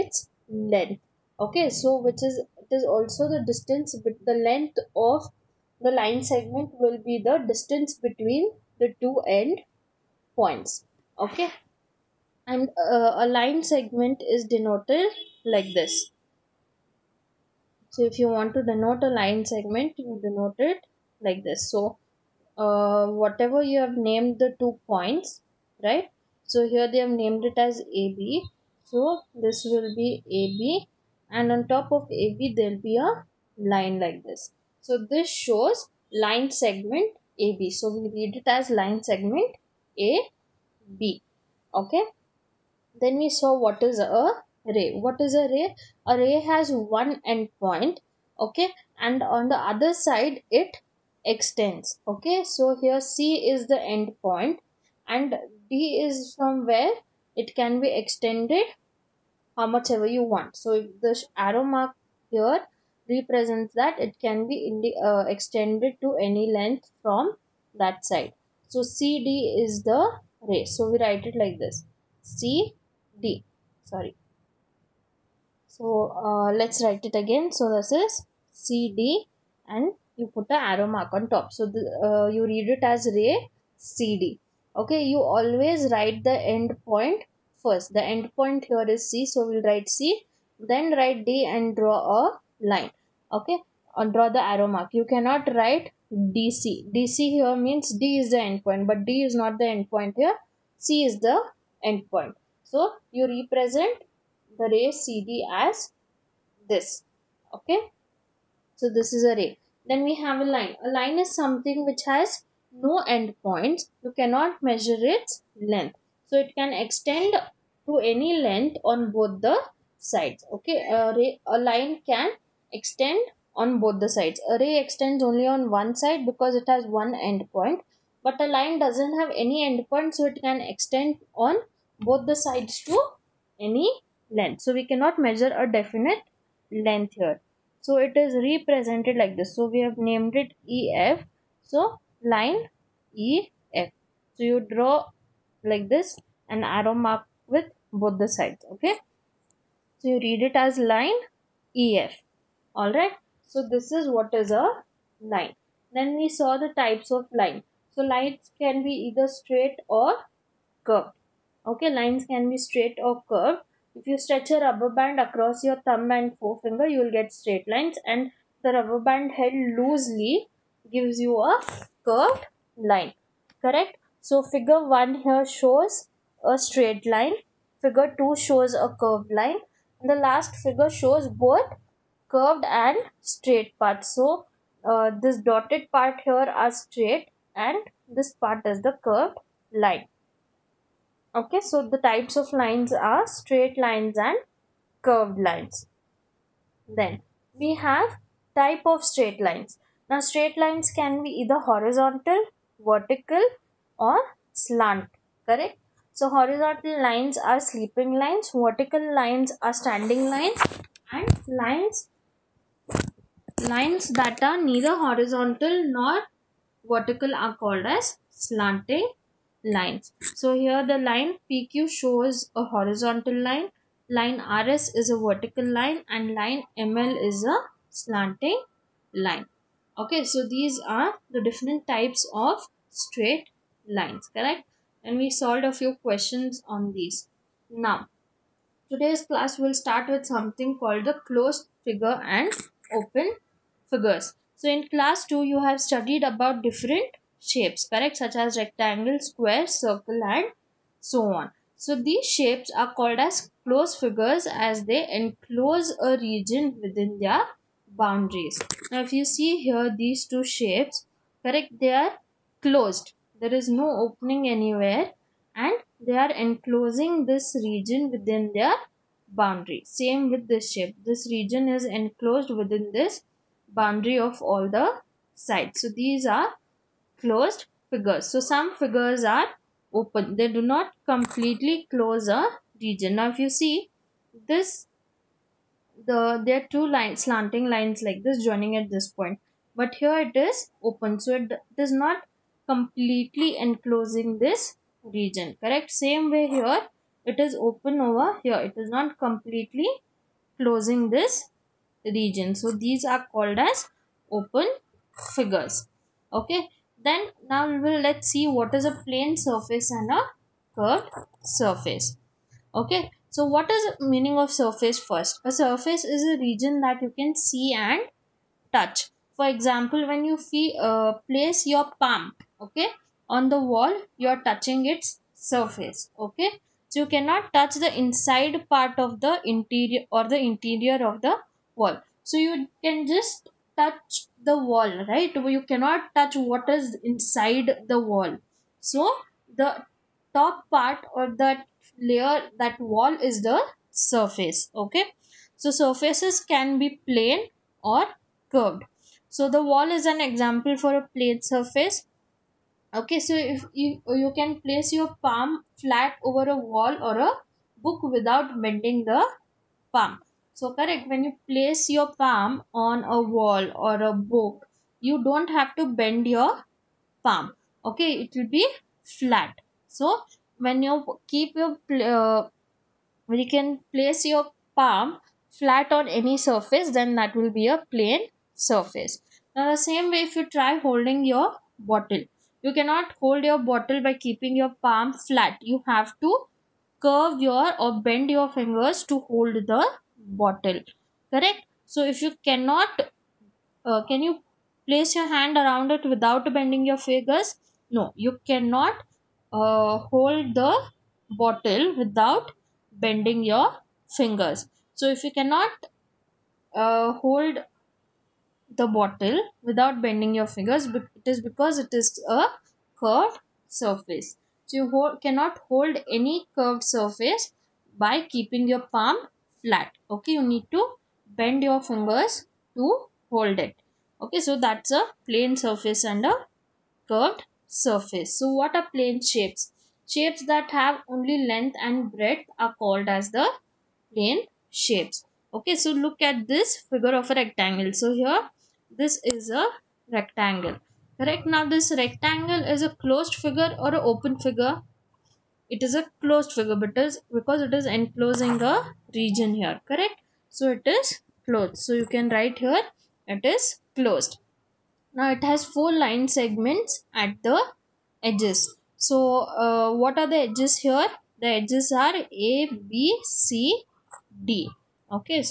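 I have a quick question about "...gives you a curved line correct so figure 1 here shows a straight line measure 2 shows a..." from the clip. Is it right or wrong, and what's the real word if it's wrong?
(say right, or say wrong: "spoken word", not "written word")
wrong: "figure", not "measure".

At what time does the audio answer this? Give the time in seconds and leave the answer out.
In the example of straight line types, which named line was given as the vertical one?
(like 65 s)
224 s.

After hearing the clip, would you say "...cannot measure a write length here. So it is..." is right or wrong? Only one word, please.
wrong.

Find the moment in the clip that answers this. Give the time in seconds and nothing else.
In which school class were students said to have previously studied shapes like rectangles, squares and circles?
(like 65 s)
244 s.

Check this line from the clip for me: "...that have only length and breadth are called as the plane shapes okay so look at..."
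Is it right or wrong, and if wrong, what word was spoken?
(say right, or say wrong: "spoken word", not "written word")
right.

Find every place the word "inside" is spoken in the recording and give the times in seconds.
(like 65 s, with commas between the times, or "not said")
327 s, 337 s.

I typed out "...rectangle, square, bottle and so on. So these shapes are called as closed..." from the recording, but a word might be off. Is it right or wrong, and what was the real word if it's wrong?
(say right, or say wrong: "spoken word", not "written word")
wrong: "circle", not "bottle".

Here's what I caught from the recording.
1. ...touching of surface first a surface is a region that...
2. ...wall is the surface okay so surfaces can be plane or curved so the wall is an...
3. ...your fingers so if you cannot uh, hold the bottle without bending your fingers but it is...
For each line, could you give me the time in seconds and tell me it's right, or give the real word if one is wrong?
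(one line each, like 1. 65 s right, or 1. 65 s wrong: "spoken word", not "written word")
1. 314 s wrong: "meaning", not "touching"
2. 342 s right
3. 403 s right.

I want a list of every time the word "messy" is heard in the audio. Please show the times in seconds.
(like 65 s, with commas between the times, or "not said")
not said.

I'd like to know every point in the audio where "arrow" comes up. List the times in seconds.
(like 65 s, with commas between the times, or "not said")
61 s, 80 s, 94 s, 146 s.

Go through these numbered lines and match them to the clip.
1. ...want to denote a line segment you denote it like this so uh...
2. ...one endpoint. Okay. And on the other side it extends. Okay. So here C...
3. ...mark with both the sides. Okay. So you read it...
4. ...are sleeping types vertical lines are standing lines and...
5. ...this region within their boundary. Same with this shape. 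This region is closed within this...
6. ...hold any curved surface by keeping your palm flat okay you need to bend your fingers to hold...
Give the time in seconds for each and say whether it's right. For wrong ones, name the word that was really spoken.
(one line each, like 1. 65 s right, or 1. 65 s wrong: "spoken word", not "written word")
1. 18 s right
2. 46 s right
3. 146 s right
4. 207 s wrong: "lines", not "types"
5. 267 s wrong: "enclosed", not "closed"
6. 415 s right.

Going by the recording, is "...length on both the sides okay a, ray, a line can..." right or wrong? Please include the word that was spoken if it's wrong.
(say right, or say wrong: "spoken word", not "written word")
right.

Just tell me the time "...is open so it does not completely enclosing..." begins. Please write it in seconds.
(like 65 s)
290 s.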